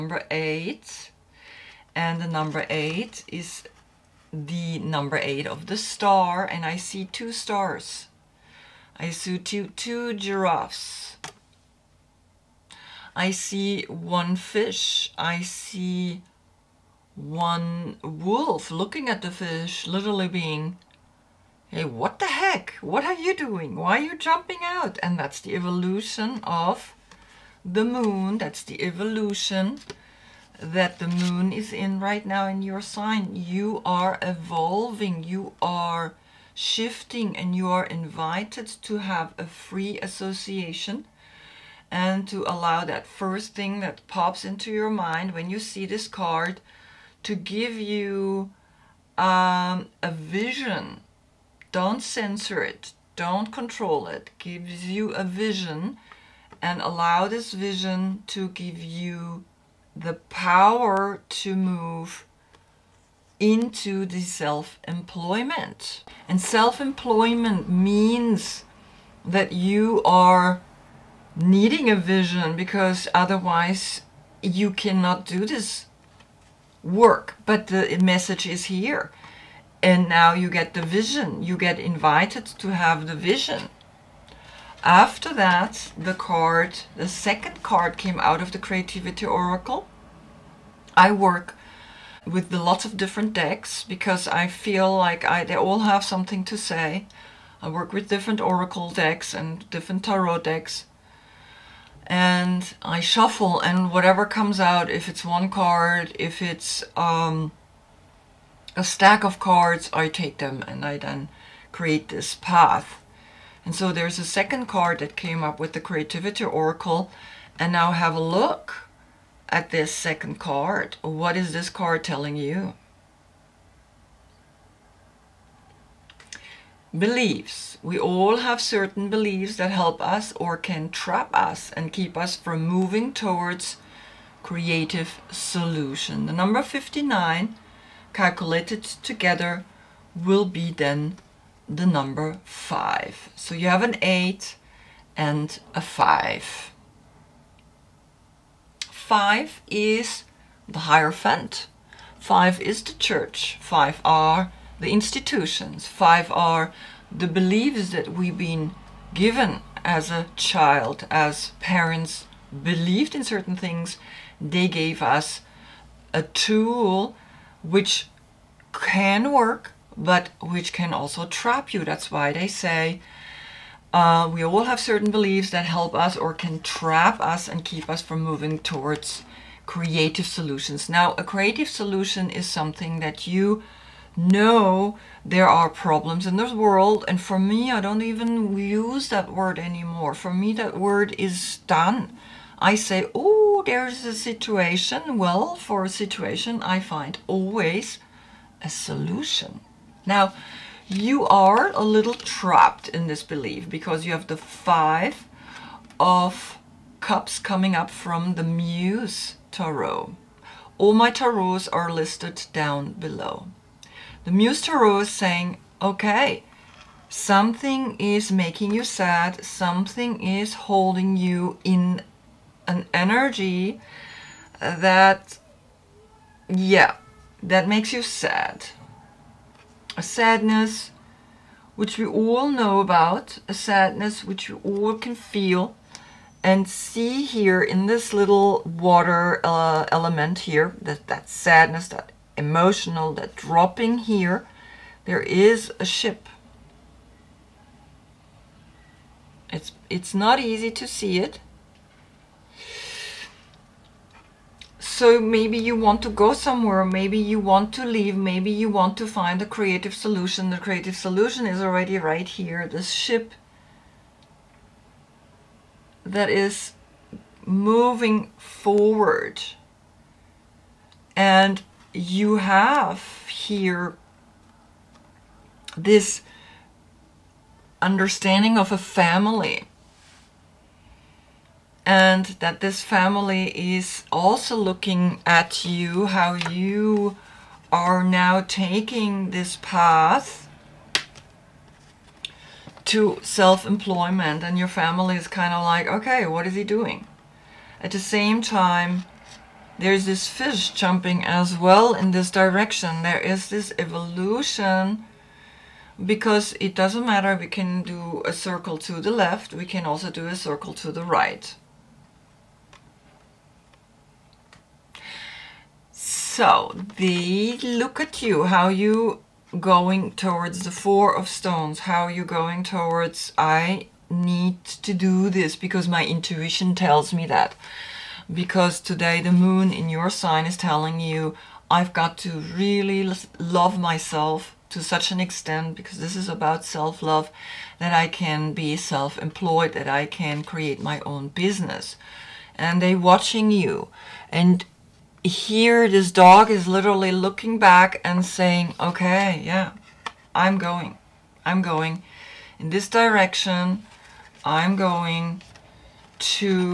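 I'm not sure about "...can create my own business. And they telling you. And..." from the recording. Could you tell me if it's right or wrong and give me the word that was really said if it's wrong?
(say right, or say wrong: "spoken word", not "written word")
wrong: "watching", not "telling".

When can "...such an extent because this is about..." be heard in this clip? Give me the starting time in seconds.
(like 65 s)
334 s.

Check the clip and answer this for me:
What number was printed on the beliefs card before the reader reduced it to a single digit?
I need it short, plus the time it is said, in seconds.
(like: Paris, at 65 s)
59, at 136 s.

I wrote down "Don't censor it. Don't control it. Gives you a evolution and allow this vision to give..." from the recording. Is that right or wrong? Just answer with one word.
wrong.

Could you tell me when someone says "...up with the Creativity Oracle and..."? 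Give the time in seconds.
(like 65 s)
115 s.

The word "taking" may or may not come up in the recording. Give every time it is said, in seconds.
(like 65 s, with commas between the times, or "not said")
288 s.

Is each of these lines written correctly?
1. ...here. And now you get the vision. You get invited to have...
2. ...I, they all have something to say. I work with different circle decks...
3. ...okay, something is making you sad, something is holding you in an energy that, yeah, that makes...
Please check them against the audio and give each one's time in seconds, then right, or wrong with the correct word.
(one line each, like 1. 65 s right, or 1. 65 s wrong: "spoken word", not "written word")
1. 78 s right
2. 95 s wrong: "oracle", not "circle"
3. 215 s right.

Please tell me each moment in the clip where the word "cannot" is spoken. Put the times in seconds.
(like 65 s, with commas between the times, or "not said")
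74 s.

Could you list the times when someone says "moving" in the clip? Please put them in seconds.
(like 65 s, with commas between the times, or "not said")
132 s, 178 s, 267 s.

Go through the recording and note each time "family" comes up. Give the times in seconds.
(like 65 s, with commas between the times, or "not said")
278 s, 282 s, 294 s.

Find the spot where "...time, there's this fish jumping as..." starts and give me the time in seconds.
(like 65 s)
298 s.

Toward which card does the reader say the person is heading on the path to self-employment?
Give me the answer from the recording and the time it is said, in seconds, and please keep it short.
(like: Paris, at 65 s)
Four of stones, at 320 s.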